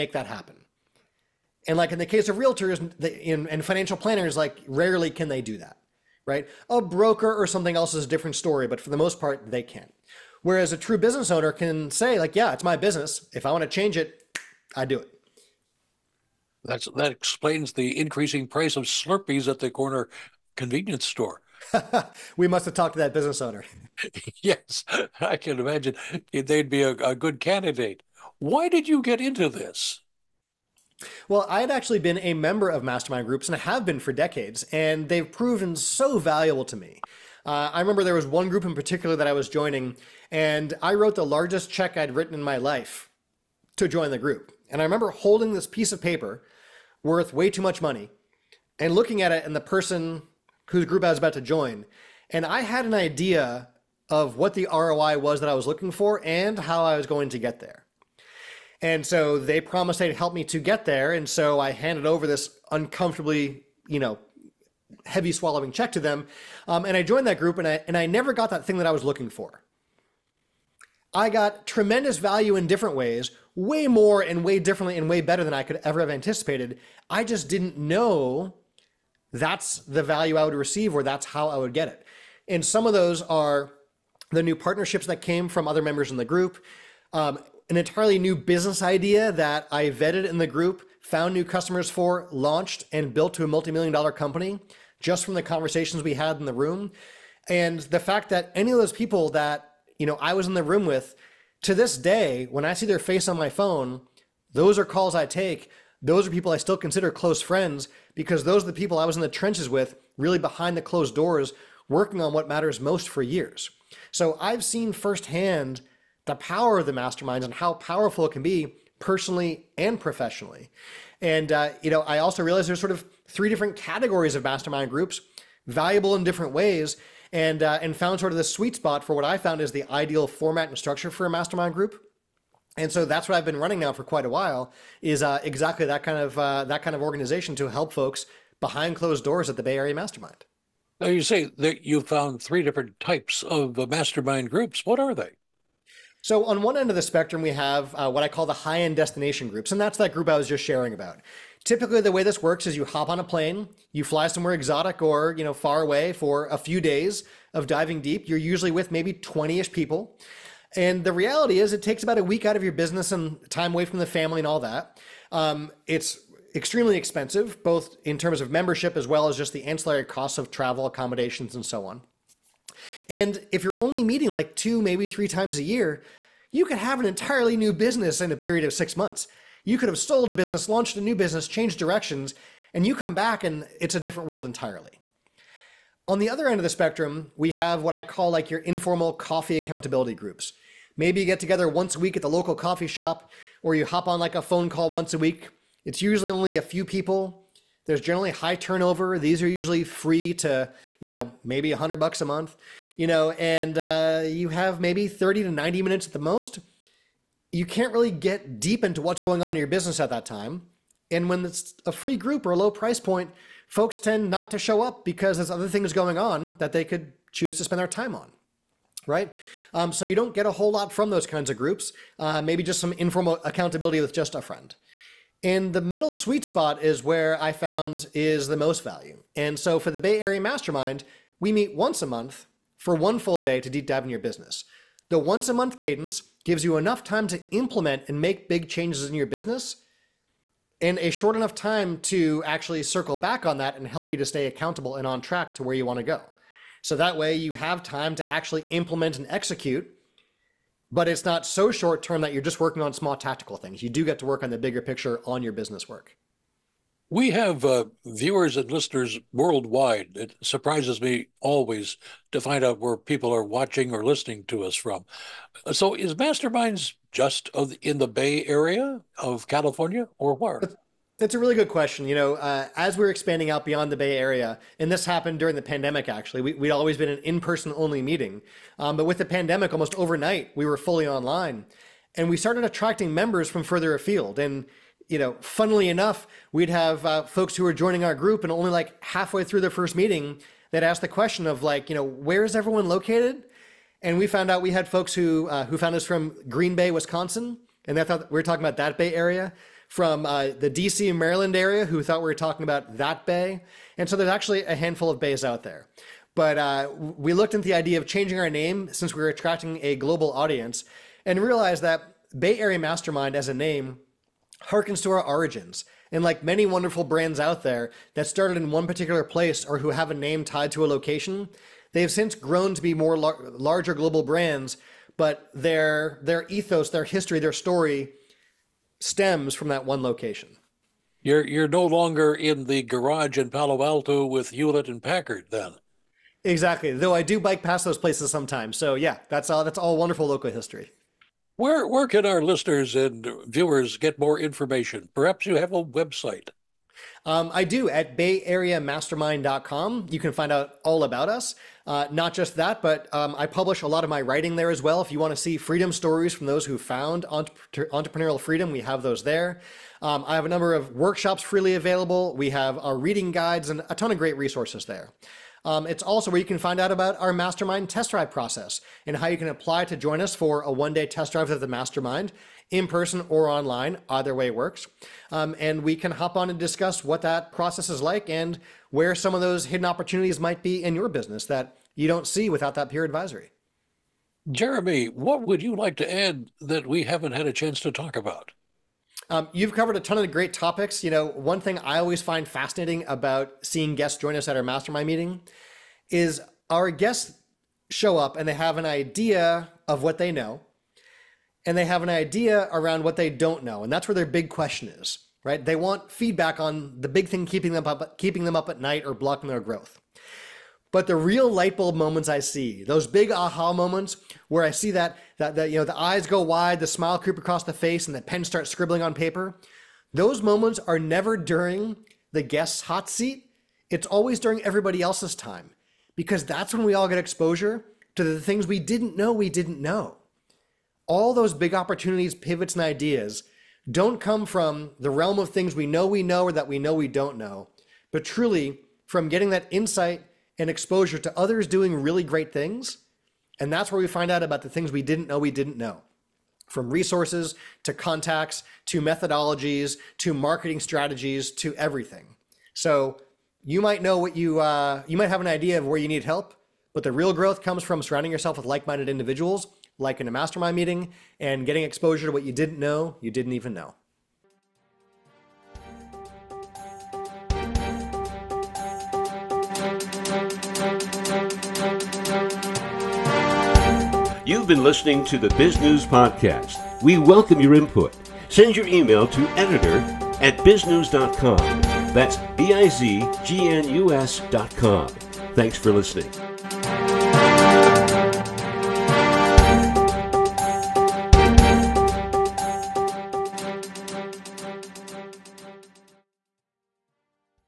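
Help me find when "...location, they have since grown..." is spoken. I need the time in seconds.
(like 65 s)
320 s.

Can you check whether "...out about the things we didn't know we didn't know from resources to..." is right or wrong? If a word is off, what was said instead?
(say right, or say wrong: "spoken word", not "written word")
right.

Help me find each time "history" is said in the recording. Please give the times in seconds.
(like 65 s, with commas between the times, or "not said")
327 s, 340 s.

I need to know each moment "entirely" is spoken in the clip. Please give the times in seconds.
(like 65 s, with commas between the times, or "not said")
87 s, 177 s, 184 s.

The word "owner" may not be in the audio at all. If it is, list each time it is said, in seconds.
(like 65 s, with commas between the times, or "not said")
11 s, 23 s.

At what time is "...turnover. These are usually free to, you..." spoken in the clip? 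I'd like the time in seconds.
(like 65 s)
198 s.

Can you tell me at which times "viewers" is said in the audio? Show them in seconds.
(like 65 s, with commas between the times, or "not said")
258 s, 343 s.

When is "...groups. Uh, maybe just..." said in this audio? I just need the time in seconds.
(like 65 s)
221 s.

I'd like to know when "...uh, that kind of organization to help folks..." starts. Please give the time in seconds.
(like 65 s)
136 s.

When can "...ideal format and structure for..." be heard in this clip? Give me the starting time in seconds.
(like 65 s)
129 s.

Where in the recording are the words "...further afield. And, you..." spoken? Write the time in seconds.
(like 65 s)
283 s.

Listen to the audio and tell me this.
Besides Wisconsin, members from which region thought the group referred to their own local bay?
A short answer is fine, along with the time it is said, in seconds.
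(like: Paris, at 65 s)
DC Maryland area, at 300 s.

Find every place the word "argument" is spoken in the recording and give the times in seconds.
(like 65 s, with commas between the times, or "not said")
not said.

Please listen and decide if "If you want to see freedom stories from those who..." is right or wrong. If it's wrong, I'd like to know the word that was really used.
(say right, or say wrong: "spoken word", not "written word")
right.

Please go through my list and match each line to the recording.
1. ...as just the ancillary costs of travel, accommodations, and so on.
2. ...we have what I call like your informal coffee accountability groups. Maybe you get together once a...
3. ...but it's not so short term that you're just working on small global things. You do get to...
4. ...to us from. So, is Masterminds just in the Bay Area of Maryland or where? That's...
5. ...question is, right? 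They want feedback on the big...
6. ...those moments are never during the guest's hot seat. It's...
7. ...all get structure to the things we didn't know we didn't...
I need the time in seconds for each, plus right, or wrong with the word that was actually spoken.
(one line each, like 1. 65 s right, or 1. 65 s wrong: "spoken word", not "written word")
1. 169 s right
2. 187 s right
3. 250 s wrong: "tactical", not "global"
4. 264 s wrong: "California", not "Maryland"
5. 404 s right
6. 420 s right
7. 426 s wrong: "exposure", not "structure".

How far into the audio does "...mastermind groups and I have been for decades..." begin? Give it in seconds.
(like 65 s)
32 s.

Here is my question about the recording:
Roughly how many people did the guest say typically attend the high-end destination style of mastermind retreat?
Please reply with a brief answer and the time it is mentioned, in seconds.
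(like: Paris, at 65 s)
20, at 159 s.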